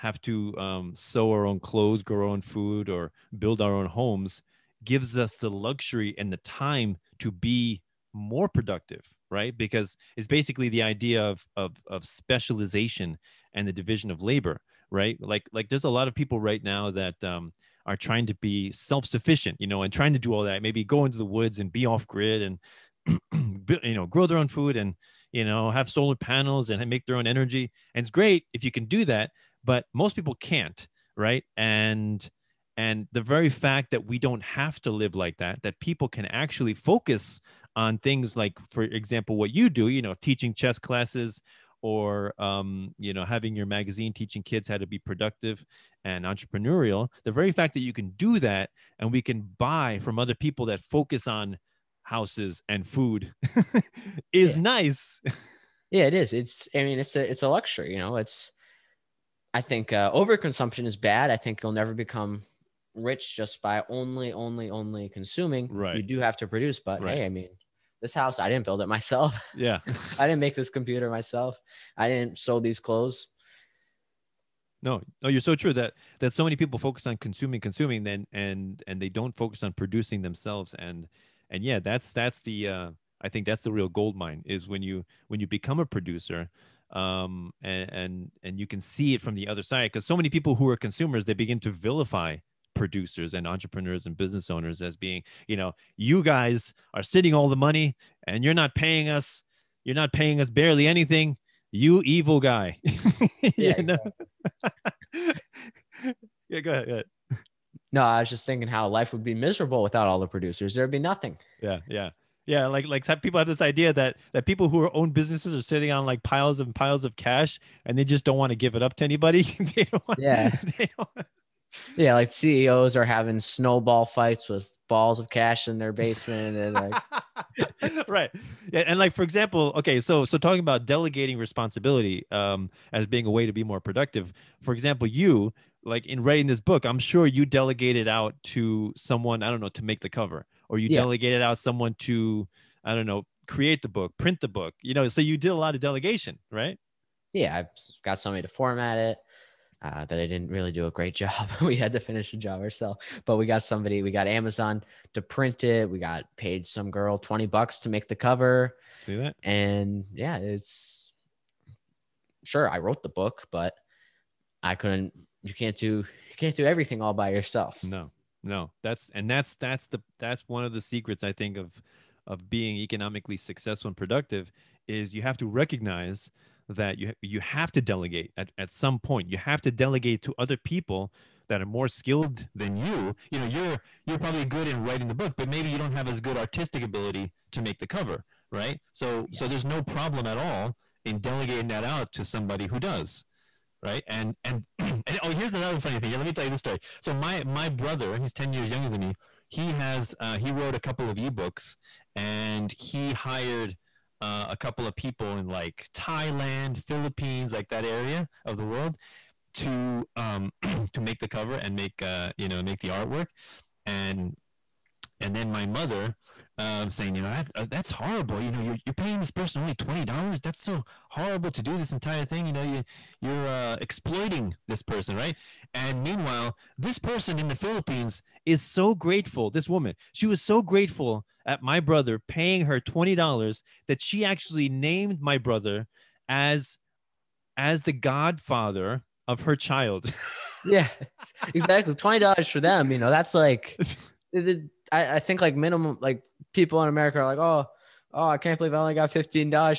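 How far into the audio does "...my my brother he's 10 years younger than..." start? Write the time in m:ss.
3:17.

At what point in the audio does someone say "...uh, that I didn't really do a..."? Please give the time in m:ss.
2:29.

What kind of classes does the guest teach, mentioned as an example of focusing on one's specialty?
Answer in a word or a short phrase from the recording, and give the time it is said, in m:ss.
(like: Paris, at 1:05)
Chess, at 0:40.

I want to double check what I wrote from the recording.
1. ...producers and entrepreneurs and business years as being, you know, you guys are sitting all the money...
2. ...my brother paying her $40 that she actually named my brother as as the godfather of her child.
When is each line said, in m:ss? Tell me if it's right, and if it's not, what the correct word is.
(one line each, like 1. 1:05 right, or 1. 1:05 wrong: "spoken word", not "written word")
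1. 1:32 wrong: "owners", not "years"
2. 3:51 wrong: "20", not "40".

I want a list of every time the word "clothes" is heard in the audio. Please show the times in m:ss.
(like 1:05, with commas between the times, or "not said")
0:01, 1:12.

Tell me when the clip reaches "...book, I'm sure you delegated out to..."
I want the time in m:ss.
2:16.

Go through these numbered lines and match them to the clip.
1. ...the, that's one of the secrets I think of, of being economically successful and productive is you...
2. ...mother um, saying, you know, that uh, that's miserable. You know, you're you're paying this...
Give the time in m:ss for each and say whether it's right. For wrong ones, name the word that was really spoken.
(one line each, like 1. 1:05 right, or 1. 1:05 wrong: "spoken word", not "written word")
1. 2:49 right
2. 3:35 wrong: "horrible", not "miserable".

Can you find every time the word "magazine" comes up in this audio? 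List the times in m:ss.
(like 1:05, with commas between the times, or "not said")
0:43.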